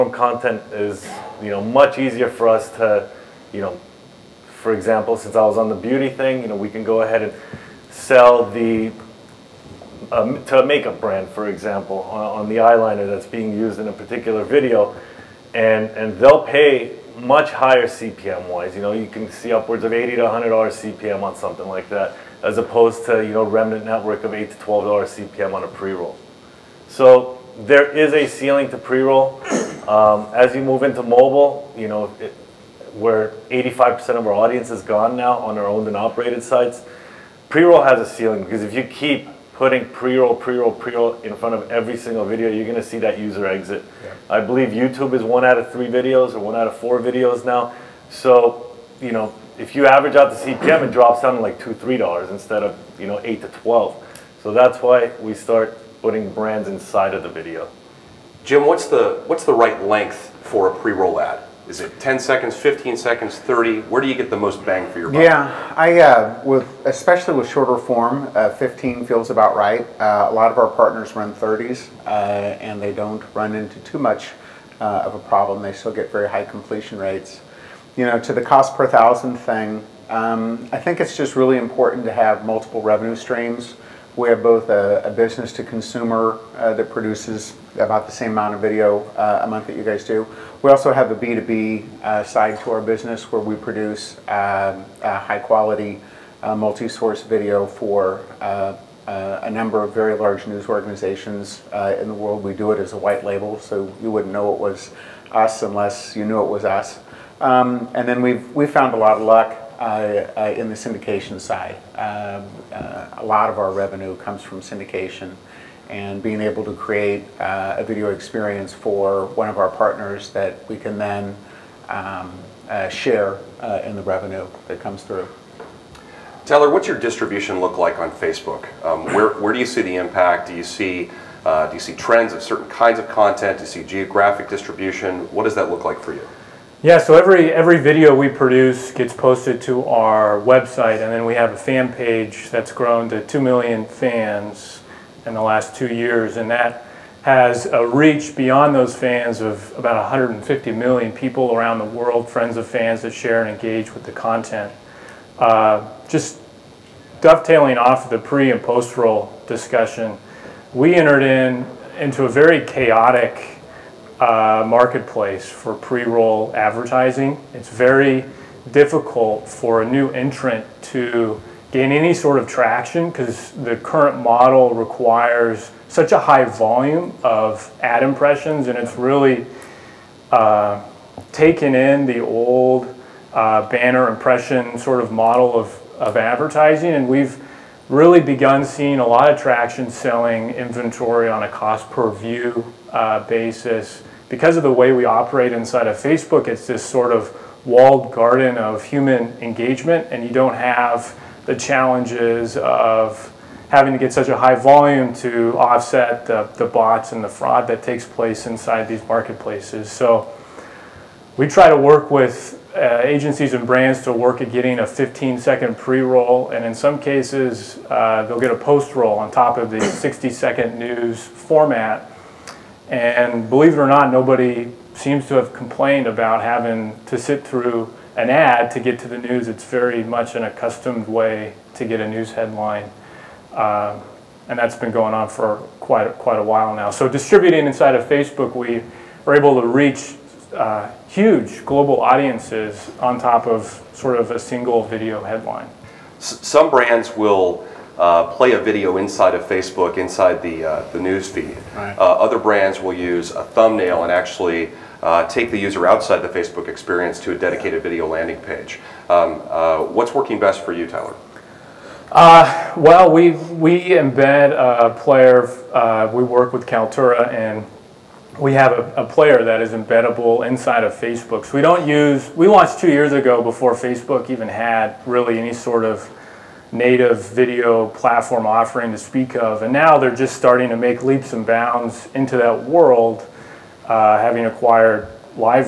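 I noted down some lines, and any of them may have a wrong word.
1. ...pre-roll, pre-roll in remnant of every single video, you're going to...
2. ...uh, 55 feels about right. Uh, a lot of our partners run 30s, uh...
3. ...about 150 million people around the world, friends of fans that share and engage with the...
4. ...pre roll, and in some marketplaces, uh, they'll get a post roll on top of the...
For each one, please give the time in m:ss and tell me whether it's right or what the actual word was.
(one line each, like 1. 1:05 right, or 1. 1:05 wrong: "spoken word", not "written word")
1. 0:40 wrong: "front", not "remnant"
2. 1:08 wrong: "15", not "55"
3. 2:29 right
4. 3:35 wrong: "cases", not "marketplaces".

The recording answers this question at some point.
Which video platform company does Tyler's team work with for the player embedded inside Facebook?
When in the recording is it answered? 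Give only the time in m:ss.
4:26.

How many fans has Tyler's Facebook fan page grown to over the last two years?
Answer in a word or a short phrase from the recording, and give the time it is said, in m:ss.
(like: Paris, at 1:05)
2 million, at 2:23.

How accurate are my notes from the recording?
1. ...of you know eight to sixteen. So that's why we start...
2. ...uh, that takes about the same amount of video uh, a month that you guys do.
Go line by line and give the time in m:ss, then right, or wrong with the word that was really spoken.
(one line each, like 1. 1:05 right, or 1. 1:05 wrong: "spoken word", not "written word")
1. 0:52 wrong: "twelve", not "sixteen"
2. 1:26 wrong: "produces", not "takes".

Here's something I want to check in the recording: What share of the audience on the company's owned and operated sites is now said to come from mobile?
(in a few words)
85%.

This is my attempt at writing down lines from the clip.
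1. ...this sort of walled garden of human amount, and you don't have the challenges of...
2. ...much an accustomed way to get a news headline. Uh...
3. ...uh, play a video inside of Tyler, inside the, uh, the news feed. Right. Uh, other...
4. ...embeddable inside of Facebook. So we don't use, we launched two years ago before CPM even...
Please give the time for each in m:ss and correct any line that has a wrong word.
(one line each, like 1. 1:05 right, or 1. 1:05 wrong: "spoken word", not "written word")
1. 3:16 wrong: "engagement", not "amount"
2. 3:50 right
3. 4:07 wrong: "Facebook", not "Tyler"
4. 4:29 wrong: "Facebook", not "CPM".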